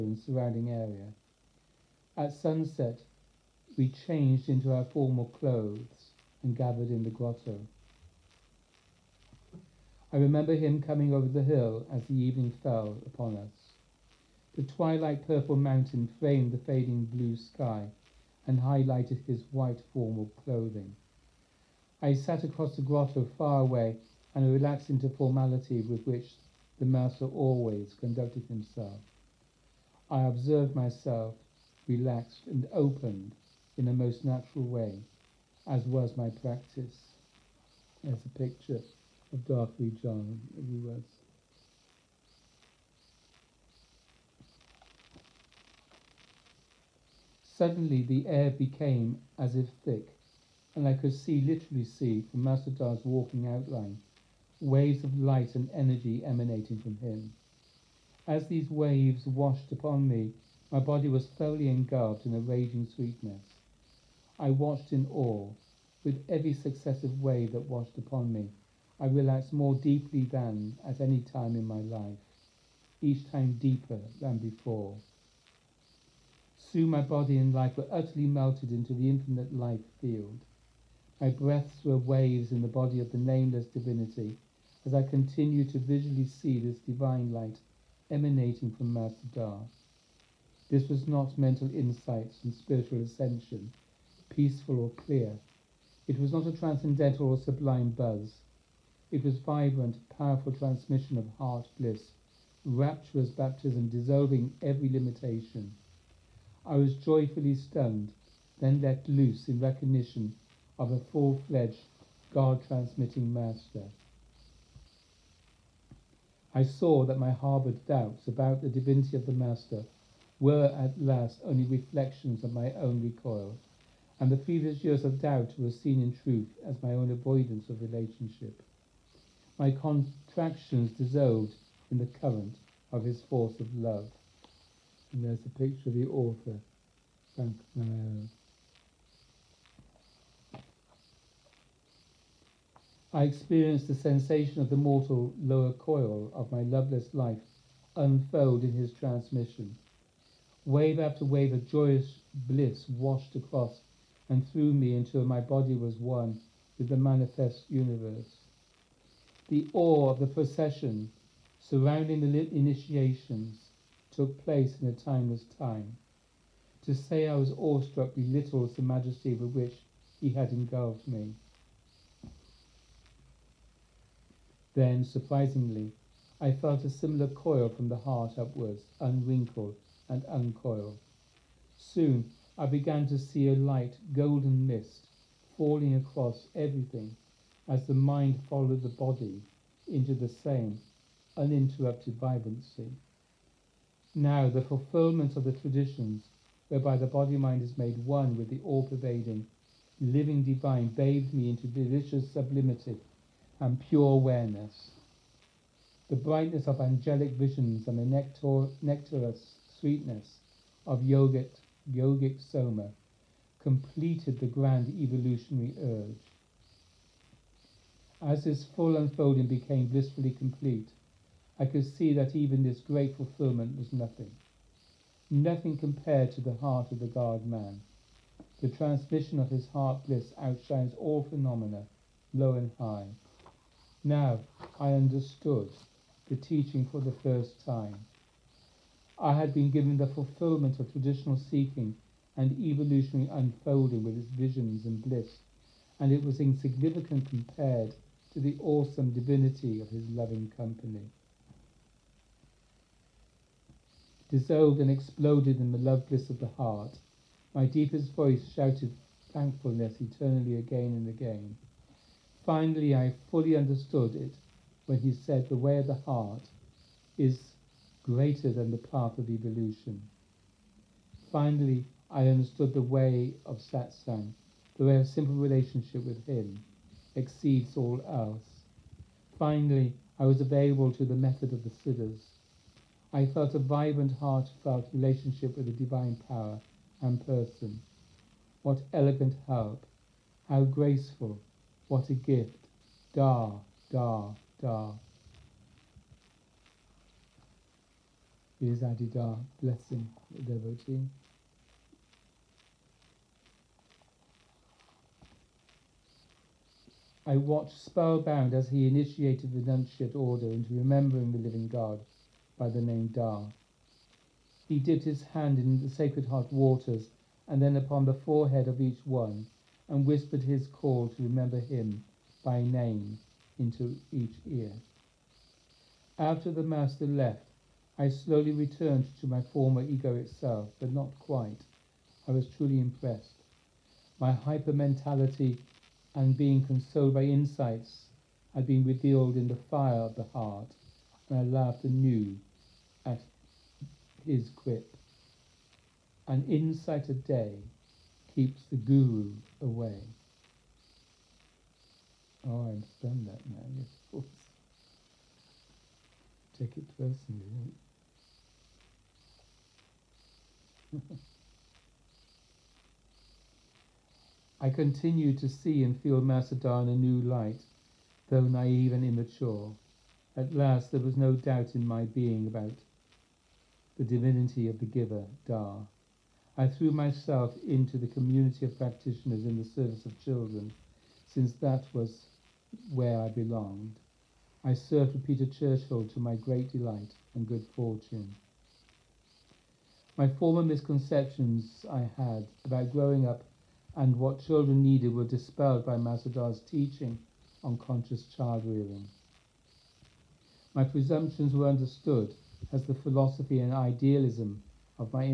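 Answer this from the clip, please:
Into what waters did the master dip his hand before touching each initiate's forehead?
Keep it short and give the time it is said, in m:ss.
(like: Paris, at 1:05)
Sacred Heart waters, at 5:15.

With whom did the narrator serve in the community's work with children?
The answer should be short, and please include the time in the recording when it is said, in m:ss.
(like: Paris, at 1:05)
Peter Churchill, at 6:25.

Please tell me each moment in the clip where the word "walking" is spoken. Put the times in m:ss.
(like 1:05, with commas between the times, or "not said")
0:53.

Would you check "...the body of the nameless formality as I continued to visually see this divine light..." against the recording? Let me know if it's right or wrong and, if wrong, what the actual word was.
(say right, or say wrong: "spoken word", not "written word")
wrong: "divinity", not "formality".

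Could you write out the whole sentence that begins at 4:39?
Finally, I was available to the method of the siddhas.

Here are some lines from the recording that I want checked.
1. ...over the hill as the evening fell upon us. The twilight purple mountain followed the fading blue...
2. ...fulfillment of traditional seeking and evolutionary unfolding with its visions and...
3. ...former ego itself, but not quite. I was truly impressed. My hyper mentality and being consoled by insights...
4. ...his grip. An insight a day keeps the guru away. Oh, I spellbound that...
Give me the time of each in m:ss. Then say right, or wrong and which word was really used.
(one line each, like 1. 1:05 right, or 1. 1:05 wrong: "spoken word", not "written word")
1. 0:11 wrong: "framed", not "followed"
2. 4:00 right
3. 5:29 right
4. 5:44 wrong: "understand", not "spellbound".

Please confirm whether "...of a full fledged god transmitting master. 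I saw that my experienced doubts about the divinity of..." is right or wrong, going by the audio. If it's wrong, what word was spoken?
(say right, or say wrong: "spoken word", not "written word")
wrong: "harboured", not "experienced".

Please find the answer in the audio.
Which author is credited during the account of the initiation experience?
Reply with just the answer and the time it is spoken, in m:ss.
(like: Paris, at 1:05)
Frank Marrero, at 2:17.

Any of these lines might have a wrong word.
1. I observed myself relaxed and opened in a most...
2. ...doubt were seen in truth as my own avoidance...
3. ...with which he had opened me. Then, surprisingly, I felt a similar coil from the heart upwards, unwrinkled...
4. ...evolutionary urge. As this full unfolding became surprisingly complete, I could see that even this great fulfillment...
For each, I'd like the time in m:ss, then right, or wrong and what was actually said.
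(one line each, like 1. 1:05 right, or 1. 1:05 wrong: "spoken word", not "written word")
1. 0:30 right
2. 2:05 right
3. 2:49 wrong: "engulfed", not "opened"
4. 3:35 wrong: "blissfully", not "surprisingly".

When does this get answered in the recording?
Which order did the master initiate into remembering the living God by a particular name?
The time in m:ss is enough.
5:09.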